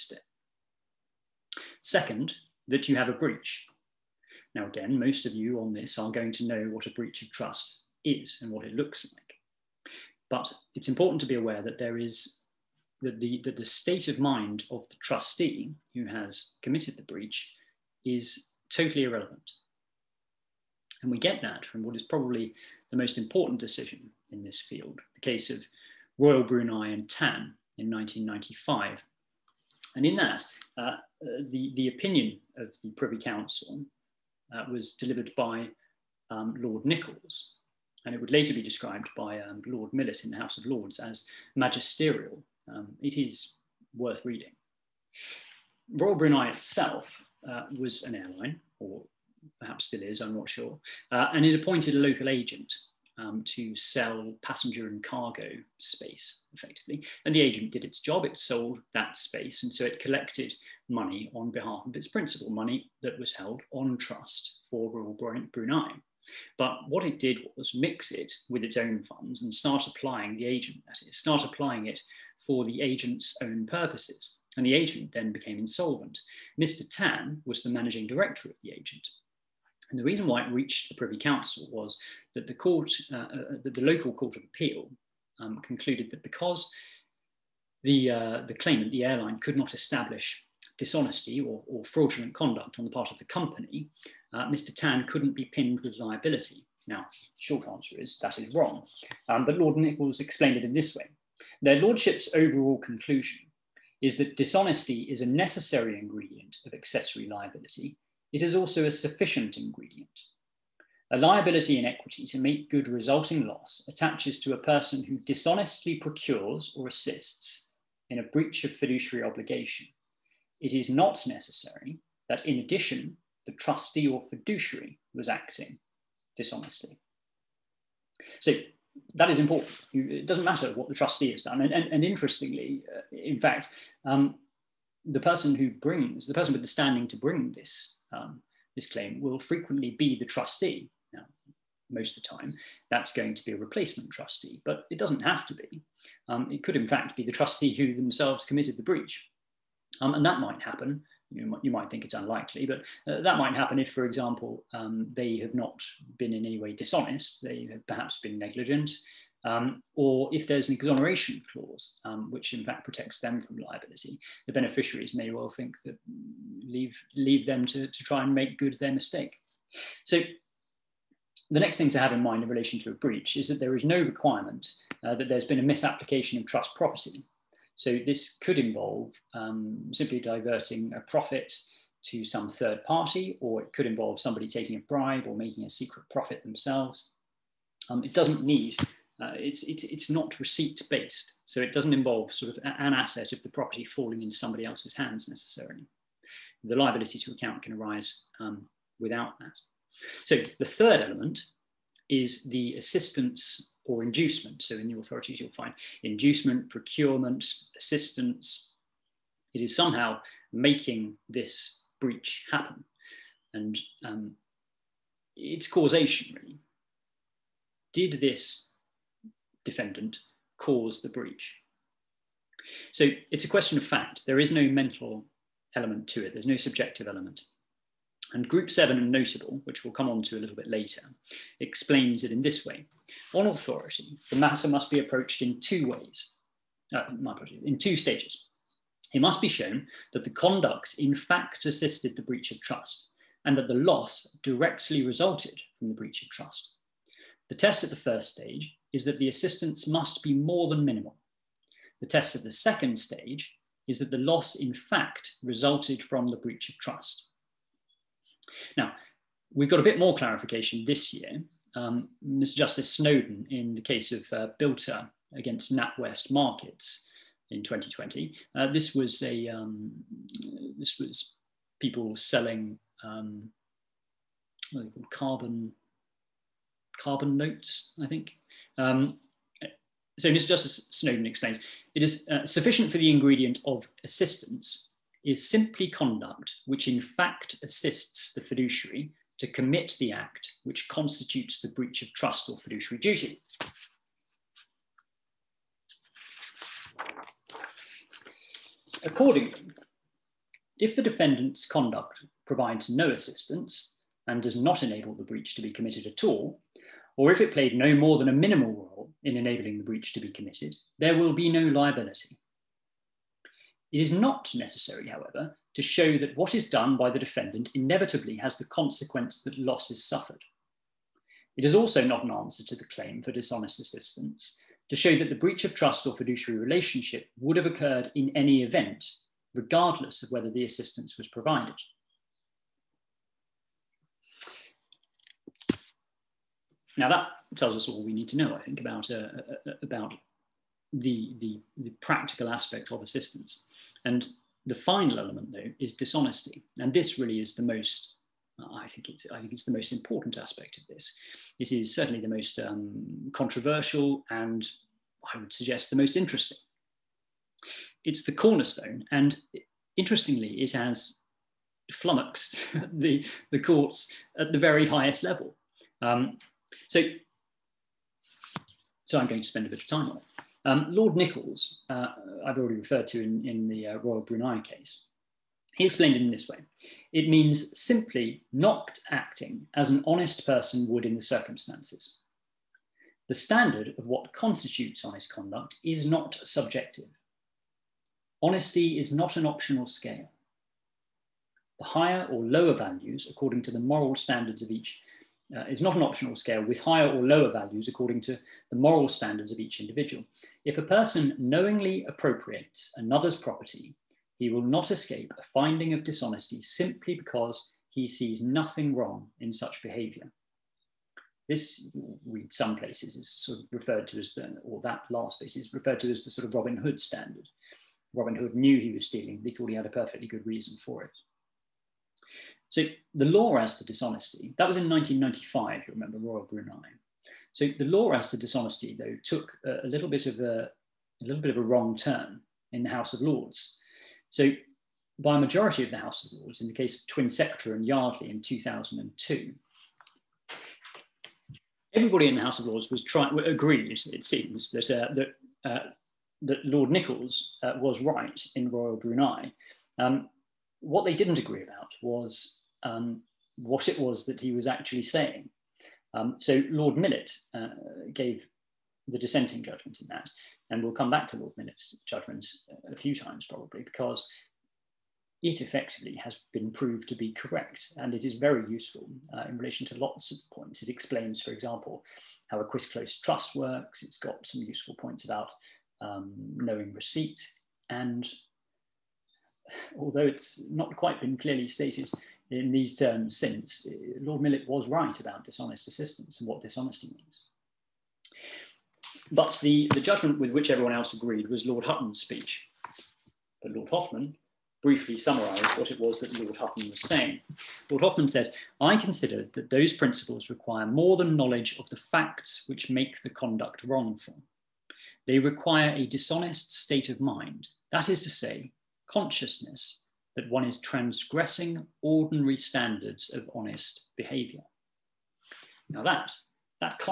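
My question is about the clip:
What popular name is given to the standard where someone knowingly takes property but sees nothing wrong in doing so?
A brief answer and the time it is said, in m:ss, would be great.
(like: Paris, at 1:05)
Robin Hood standard, at 6:56.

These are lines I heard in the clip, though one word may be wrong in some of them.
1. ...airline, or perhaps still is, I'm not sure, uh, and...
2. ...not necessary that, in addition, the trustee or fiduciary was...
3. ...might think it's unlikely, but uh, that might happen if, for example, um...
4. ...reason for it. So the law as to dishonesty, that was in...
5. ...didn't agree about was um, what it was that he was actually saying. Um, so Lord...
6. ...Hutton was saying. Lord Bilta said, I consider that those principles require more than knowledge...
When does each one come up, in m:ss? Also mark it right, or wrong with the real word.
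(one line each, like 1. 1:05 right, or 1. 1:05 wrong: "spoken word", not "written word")
1. 0:48 right
2. 2:00 right
3. 2:31 right
4. 7:00 right
5. 7:31 right
6. 8:16 wrong: "Hoffmann", not "Bilta".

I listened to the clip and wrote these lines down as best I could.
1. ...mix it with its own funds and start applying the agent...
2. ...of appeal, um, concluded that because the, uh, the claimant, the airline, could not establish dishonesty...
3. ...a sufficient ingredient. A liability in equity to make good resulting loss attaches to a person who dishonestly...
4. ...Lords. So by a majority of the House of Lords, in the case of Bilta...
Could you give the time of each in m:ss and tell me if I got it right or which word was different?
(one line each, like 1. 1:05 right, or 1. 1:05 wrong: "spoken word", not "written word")
1. 1:07 right
2. 1:24 right
3. 1:48 right
4. 7:13 wrong: "Twinsectra", not "Bilta".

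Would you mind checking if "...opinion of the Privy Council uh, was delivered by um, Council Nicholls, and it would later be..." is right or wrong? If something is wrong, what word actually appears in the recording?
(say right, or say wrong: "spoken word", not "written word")
wrong: "Lord", not "Council".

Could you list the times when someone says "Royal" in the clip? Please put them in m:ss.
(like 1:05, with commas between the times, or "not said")
0:26, 0:45, 1:04, 6:13, 7:06, 7:28.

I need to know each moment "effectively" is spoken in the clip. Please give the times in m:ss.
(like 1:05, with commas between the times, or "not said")
0:56, 7:45.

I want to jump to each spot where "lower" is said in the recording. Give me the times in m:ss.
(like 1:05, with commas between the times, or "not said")
6:32, 6:37.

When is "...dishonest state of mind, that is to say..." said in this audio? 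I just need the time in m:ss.
8:26.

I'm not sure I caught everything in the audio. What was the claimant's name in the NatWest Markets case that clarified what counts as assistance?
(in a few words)
Bilta.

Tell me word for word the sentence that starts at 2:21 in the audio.
Now, most of the time, that's going to be a replacement trustee, but it doesn't have to be.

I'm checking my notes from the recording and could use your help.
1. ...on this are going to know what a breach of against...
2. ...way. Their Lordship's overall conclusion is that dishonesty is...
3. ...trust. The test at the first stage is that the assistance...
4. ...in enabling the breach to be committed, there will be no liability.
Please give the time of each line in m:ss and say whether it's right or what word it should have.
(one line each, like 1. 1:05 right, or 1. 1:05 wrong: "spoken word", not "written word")
1. 0:05 wrong: "trust", not "against"
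2. 1:40 right
3. 4:06 right
4. 5:09 right.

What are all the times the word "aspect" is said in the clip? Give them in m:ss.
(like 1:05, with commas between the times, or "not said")
5:42, 5:50.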